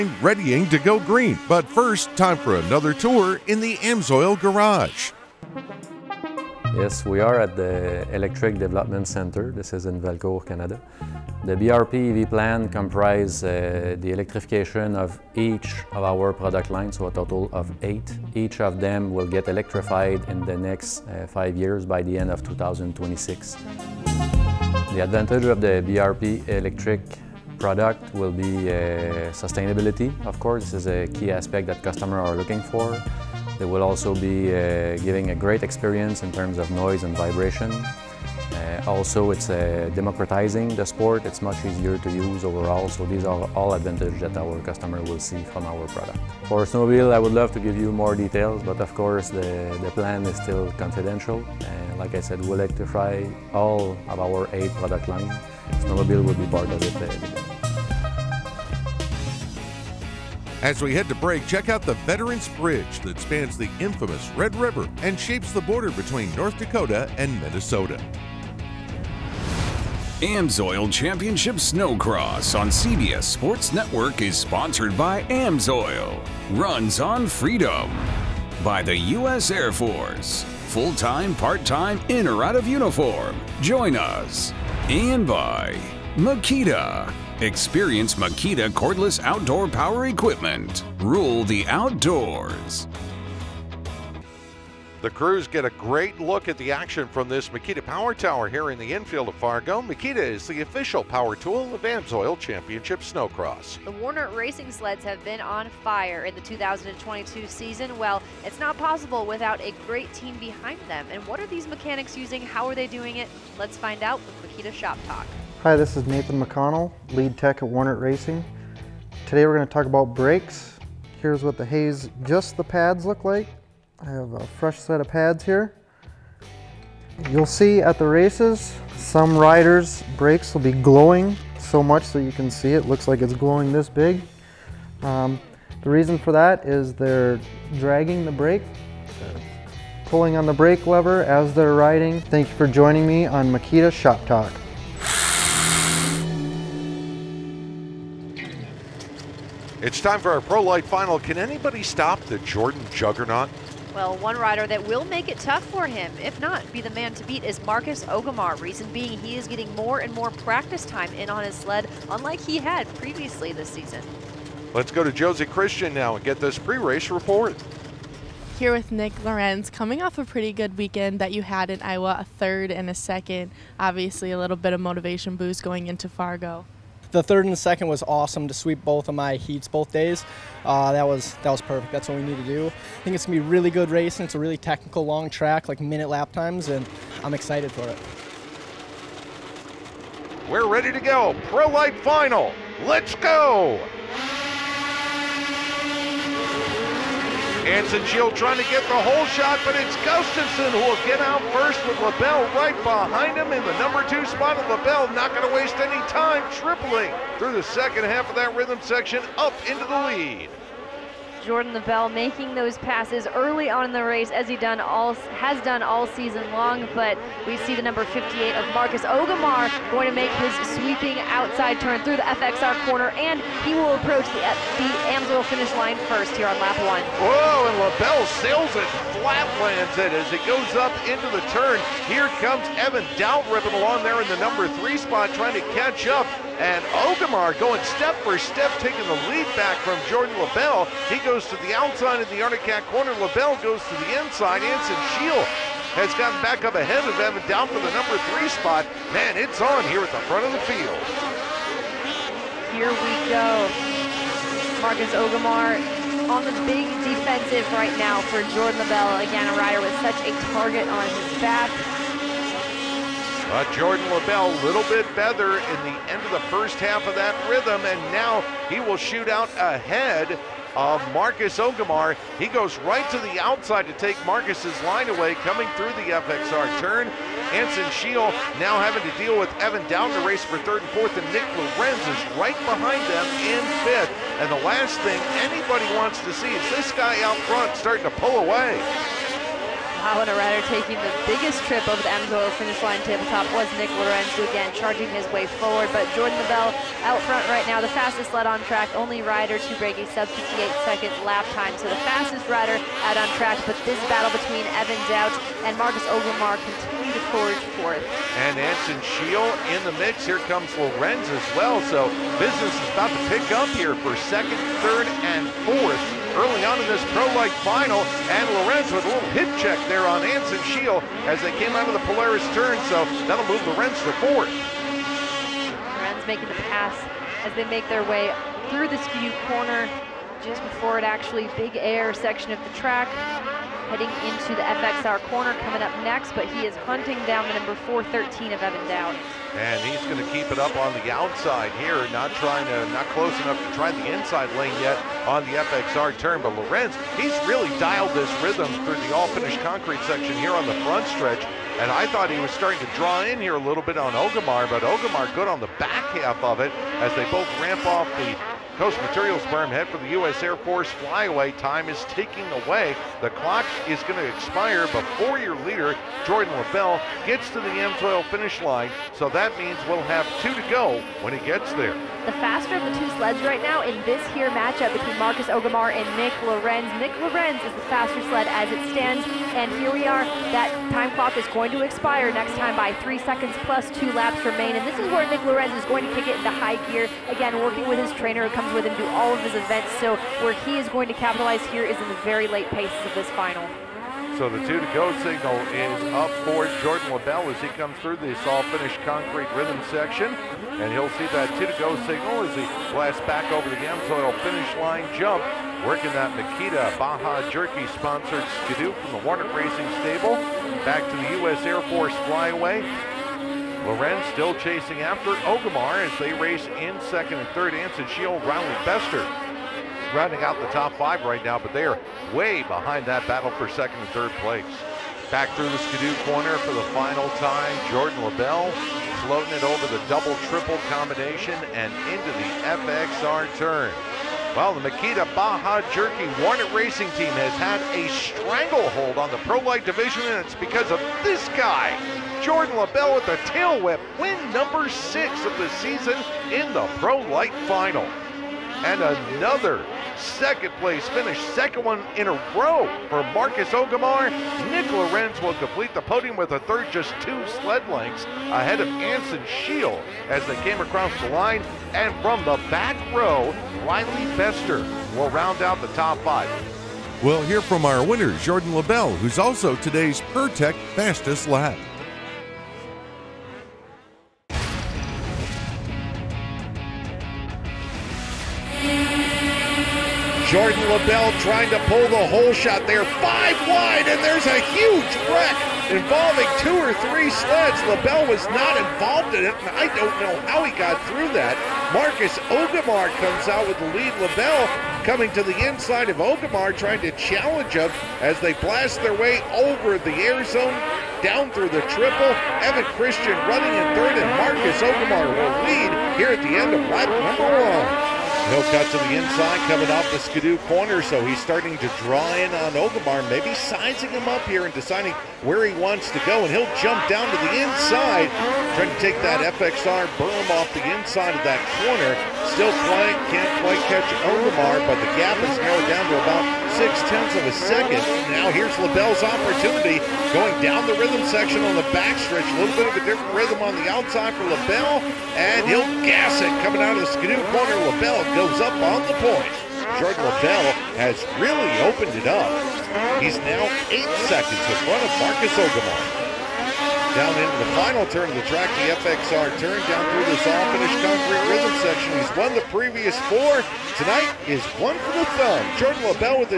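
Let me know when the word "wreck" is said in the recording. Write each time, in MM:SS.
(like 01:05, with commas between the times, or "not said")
08:05.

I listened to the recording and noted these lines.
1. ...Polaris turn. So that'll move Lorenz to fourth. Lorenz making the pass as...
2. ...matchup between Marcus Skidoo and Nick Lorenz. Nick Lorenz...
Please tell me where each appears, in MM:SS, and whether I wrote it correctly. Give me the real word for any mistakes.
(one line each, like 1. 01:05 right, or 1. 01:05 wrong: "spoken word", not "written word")
1. 05:22 right
2. 06:14 wrong: "Ogemar", not "Skidoo".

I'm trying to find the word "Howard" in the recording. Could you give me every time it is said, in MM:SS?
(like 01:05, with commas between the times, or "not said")
04:50.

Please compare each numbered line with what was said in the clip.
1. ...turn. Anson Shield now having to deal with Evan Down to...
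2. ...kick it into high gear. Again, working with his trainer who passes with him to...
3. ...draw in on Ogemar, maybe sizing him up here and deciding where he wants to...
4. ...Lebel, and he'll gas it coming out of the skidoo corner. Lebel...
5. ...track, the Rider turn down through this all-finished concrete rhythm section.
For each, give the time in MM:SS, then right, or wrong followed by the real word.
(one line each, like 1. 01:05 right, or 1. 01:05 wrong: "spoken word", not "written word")
1. 04:36 right
2. 06:26 wrong: "comes", not "passes"
3. 08:32 right
4. 08:54 right
5. 09:08 wrong: "FXR", not "Rider".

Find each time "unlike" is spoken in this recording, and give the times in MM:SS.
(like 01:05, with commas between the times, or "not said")
02:42.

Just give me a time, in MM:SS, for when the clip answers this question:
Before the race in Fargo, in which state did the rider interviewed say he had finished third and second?
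02:51.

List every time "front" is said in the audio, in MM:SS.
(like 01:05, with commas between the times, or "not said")
04:10, 04:47, 04:57, 05:50, 09:04.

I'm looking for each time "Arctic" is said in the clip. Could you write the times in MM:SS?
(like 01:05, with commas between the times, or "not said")
04:02.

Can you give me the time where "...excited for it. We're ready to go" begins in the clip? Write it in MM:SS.
03:07.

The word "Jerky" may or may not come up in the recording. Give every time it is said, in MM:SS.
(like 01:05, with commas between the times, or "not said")
06:47, 07:15.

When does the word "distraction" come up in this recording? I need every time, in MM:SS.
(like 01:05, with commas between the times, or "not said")
not said.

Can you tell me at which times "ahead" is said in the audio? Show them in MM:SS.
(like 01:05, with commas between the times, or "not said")
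04:06, 04:29, 07:38.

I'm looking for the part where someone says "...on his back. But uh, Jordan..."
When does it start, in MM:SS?
04:20.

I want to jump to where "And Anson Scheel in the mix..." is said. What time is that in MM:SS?
05:08.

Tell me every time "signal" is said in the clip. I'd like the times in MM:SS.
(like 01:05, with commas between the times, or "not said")
06:35, 06:42.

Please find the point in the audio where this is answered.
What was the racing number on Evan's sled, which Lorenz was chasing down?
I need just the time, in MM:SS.
05:37.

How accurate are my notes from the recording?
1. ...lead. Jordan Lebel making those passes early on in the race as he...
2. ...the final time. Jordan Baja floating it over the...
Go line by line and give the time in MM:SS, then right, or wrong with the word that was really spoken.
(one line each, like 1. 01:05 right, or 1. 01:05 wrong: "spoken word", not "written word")
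1. 03:29 right
2. 07:06 wrong: "Lebel", not "Baja".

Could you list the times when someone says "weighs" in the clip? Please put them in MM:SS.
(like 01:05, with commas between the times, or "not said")
not said.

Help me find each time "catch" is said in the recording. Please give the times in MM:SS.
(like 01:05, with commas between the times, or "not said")
03:55, 08:43.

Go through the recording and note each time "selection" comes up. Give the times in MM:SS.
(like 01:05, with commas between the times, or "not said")
not said.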